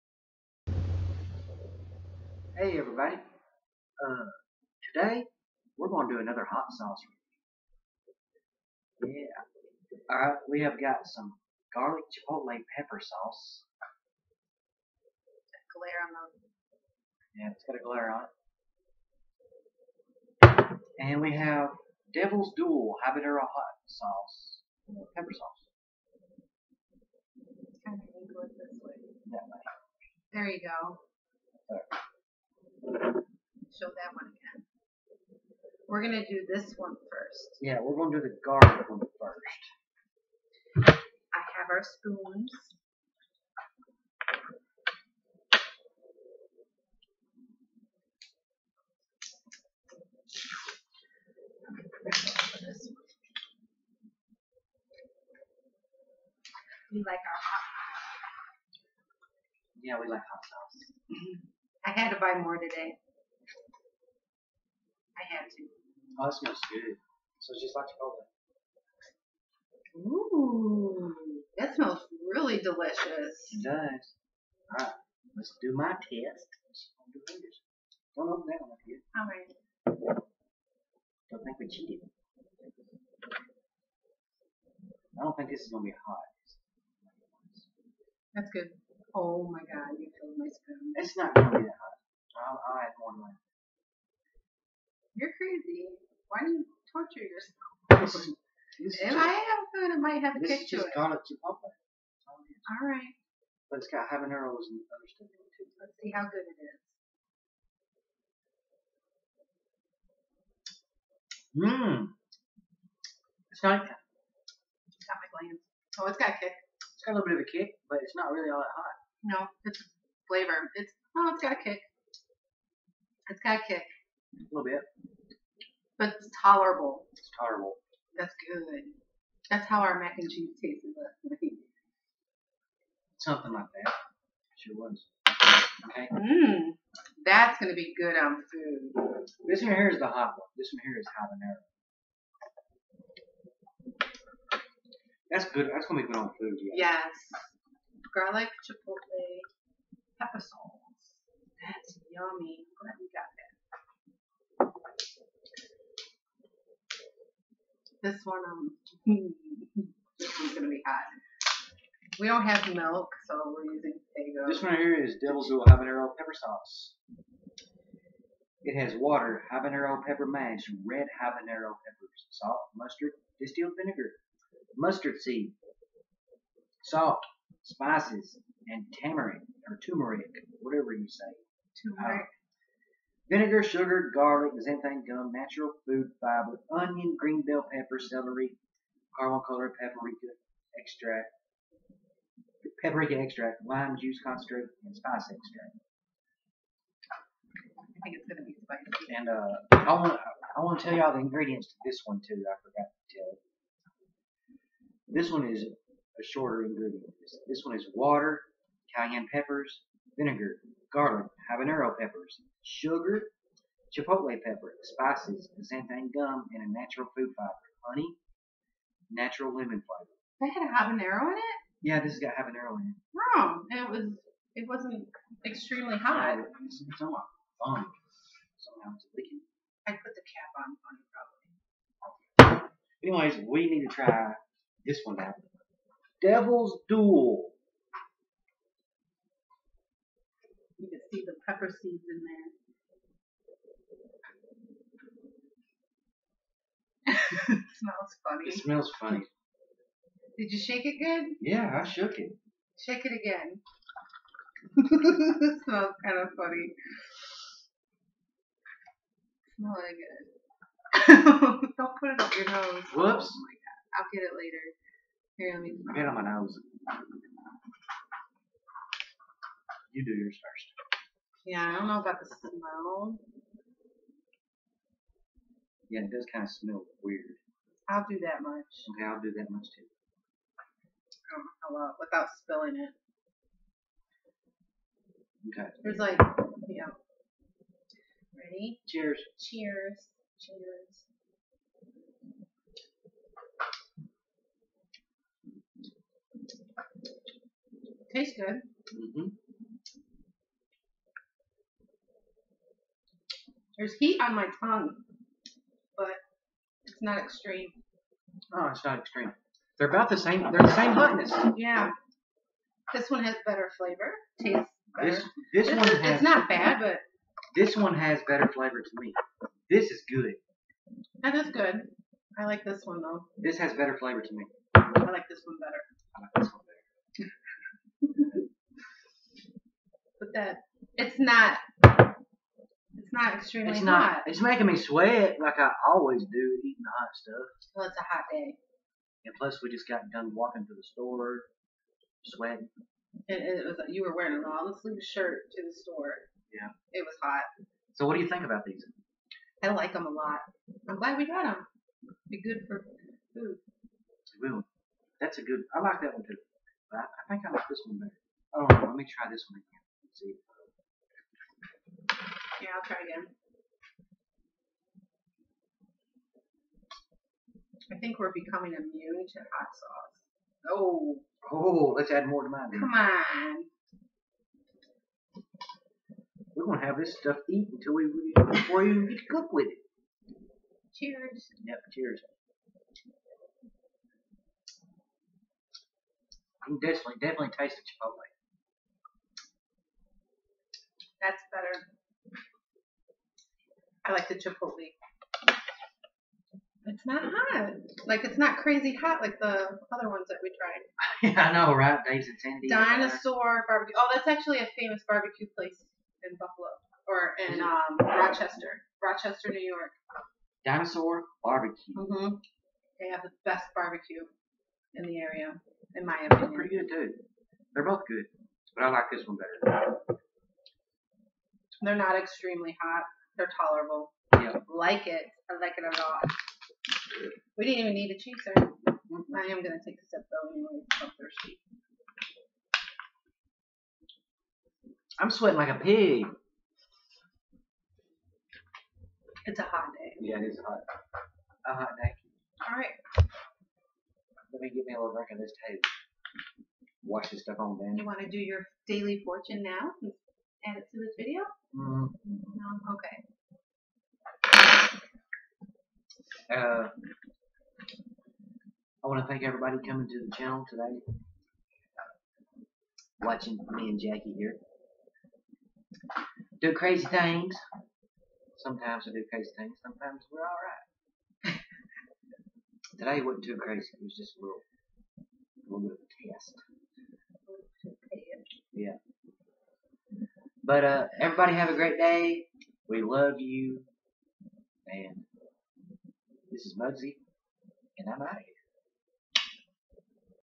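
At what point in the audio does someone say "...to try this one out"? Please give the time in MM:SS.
03:53.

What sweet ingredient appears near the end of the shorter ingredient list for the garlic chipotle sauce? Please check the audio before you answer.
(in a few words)
Honey.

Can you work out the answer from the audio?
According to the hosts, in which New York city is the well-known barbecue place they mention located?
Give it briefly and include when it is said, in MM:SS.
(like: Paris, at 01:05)
Rochester, at 06:49.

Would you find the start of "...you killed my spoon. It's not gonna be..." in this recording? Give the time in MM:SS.
01:29.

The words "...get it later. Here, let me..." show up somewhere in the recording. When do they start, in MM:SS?
04:24.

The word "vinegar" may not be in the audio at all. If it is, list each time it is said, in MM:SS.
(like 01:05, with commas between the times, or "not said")
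02:53, 03:03, 03:30.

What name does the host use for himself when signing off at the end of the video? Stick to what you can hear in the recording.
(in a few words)
Mugzee.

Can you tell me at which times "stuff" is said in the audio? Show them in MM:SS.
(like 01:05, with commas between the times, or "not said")
01:45, 05:37, 06:17, 07:27.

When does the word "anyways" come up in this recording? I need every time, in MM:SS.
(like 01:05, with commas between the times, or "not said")
03:53, 07:10.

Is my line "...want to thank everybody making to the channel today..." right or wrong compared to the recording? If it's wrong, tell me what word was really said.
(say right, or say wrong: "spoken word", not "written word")
wrong: "coming", not "making".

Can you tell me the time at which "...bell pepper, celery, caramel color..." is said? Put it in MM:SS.
03:07.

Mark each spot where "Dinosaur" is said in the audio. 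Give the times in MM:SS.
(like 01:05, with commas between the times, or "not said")
06:42, 06:50.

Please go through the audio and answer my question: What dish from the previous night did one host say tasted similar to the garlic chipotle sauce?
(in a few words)
Mac and cheese.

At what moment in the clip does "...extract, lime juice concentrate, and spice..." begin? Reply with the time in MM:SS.
03:13.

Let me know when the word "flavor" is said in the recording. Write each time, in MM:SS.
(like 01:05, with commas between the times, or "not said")
02:00, 03:39, 05:13, 05:18, 05:23.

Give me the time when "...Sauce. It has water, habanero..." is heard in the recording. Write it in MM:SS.
02:46.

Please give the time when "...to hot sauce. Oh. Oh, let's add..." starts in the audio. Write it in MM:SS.
06:09.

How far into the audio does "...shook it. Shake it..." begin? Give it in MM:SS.
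04:11.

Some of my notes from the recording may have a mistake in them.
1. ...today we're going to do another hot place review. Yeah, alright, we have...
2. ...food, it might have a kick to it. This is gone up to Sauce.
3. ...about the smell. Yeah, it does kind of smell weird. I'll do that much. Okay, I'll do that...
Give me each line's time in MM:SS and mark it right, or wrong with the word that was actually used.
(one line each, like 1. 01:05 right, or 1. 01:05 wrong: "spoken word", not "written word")
1. 00:04 wrong: "sauce", not "place"
2. 01:39 wrong: "Popeye", not "Sauce"
3. 04:31 right.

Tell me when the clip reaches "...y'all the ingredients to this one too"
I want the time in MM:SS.
03:20.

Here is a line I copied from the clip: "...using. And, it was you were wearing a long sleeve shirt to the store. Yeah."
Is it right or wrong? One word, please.
wrong.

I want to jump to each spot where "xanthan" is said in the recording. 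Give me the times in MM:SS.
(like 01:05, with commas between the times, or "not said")
03:04, 03:35.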